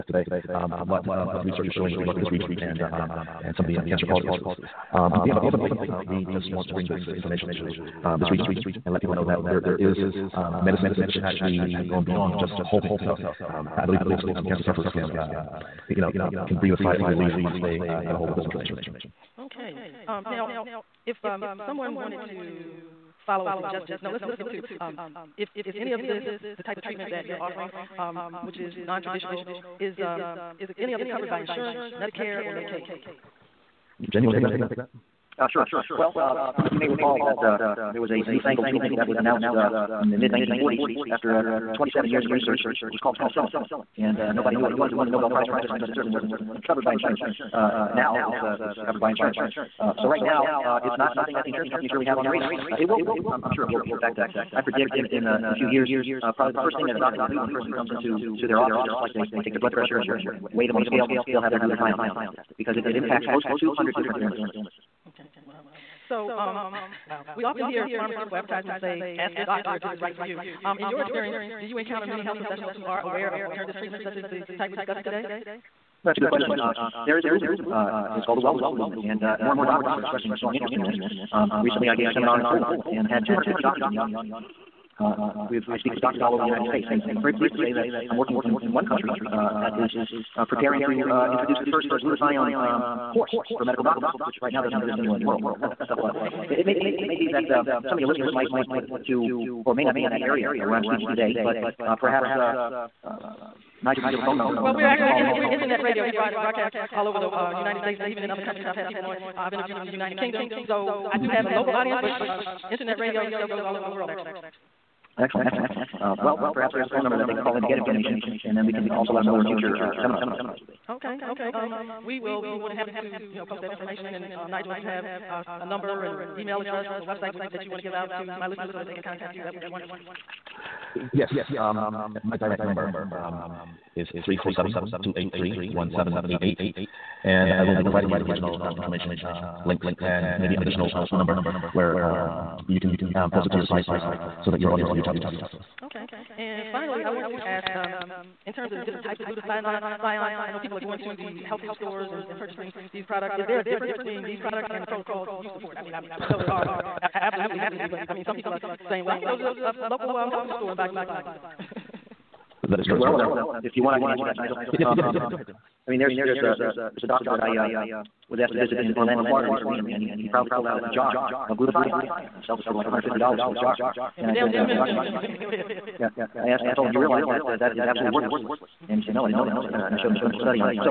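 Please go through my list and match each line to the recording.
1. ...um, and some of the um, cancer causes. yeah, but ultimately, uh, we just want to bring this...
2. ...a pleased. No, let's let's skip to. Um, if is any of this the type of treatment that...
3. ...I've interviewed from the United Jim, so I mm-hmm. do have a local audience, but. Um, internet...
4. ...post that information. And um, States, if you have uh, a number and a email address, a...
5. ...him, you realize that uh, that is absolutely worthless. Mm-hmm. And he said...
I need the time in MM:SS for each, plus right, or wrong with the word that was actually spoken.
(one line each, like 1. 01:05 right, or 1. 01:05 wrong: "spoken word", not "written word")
1. 00:02 right
2. 00:23 wrong: "suggested", not "pleased"
3. 01:49 wrong: "Kingdom", not "Jim"
4. 02:03 wrong: "Nigel", not "States"
5. 02:56 right.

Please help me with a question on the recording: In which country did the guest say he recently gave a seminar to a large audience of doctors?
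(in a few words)
Poland.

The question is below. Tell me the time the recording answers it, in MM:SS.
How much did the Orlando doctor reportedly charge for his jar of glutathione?
02:52.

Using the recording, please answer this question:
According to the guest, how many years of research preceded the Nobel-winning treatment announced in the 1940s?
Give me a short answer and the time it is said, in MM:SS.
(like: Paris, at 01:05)
27, at 00:41.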